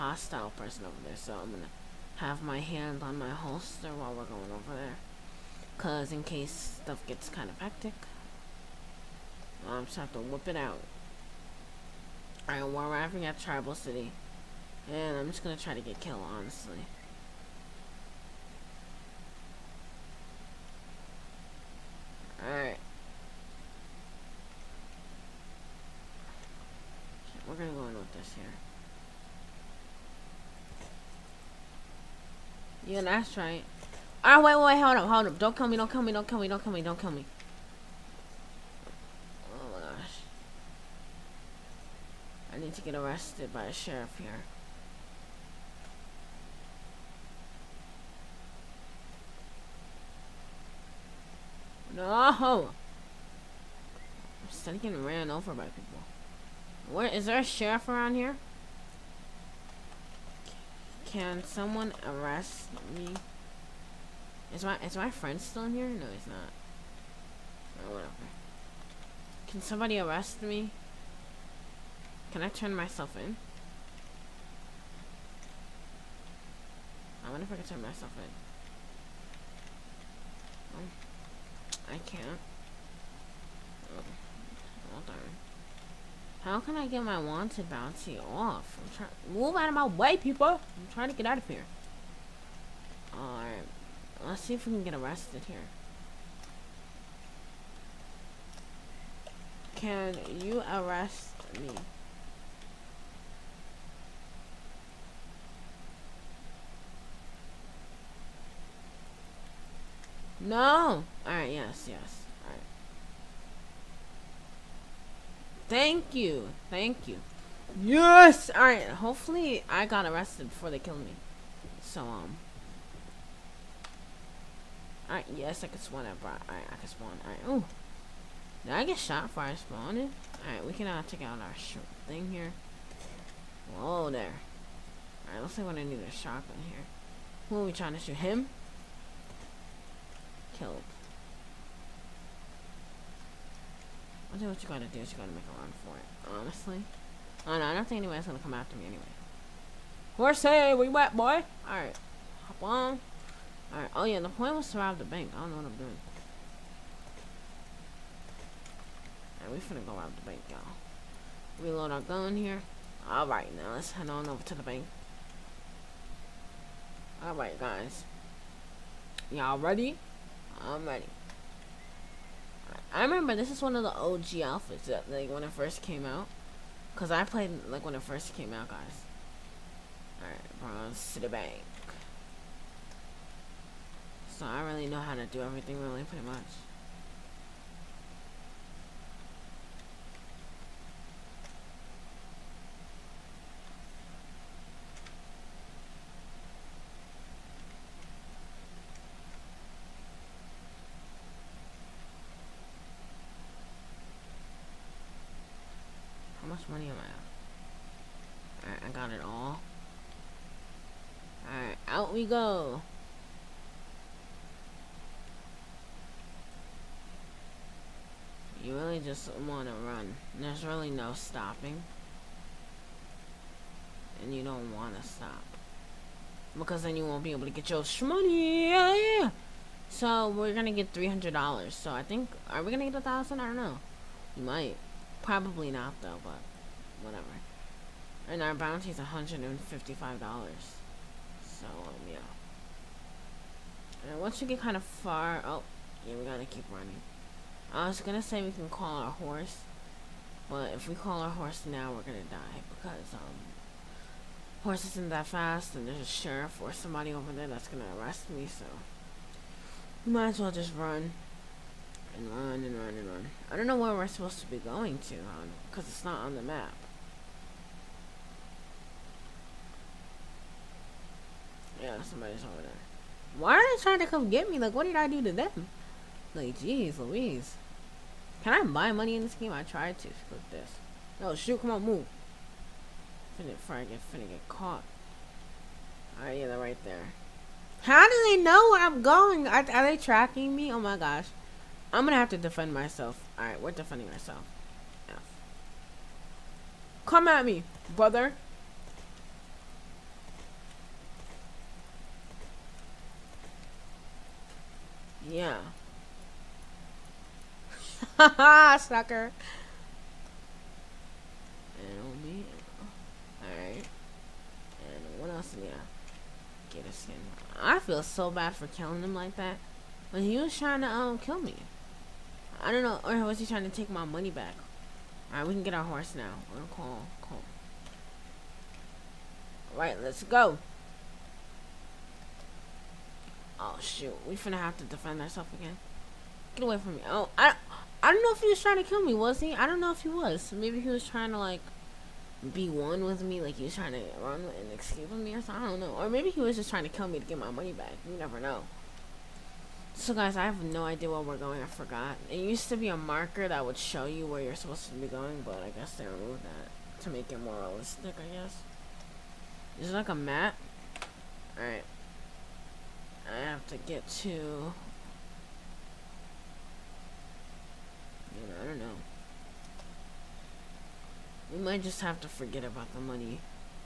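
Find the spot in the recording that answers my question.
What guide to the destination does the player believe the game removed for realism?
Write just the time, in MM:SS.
05:52.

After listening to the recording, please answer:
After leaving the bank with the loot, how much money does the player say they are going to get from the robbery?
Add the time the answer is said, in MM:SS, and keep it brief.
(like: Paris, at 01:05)
$300, at 03:50.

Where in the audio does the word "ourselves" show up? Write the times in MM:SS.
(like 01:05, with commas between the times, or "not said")
04:54, 05:35.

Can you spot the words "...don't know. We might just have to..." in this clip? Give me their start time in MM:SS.
06:08.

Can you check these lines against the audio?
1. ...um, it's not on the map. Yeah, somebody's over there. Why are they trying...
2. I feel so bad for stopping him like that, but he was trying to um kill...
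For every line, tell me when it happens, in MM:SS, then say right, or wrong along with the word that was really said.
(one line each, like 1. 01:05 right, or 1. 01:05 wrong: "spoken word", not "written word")
1. 04:25 right
2. 05:17 wrong: "killing", not "stopping".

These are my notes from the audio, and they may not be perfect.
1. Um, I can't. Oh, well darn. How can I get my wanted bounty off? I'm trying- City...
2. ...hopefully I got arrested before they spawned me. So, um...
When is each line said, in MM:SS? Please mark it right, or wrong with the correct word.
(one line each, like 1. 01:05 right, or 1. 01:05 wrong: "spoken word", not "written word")
1. 01:20 wrong: "Move", not "City"
2. 01:58 wrong: "killed", not "spawned".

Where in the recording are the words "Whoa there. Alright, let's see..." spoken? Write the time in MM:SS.
02:13.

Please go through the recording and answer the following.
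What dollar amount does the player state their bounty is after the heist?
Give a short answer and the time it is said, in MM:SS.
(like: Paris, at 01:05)
$155, at 03:58.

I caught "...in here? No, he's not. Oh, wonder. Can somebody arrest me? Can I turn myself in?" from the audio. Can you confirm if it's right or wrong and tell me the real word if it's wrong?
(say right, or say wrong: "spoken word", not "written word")
wrong: "whatever", not "wonder".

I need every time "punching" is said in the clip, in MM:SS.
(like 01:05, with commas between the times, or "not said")
not said.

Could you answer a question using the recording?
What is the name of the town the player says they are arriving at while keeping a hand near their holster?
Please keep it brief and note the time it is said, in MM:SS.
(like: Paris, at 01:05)
Tribal City, at 00:13.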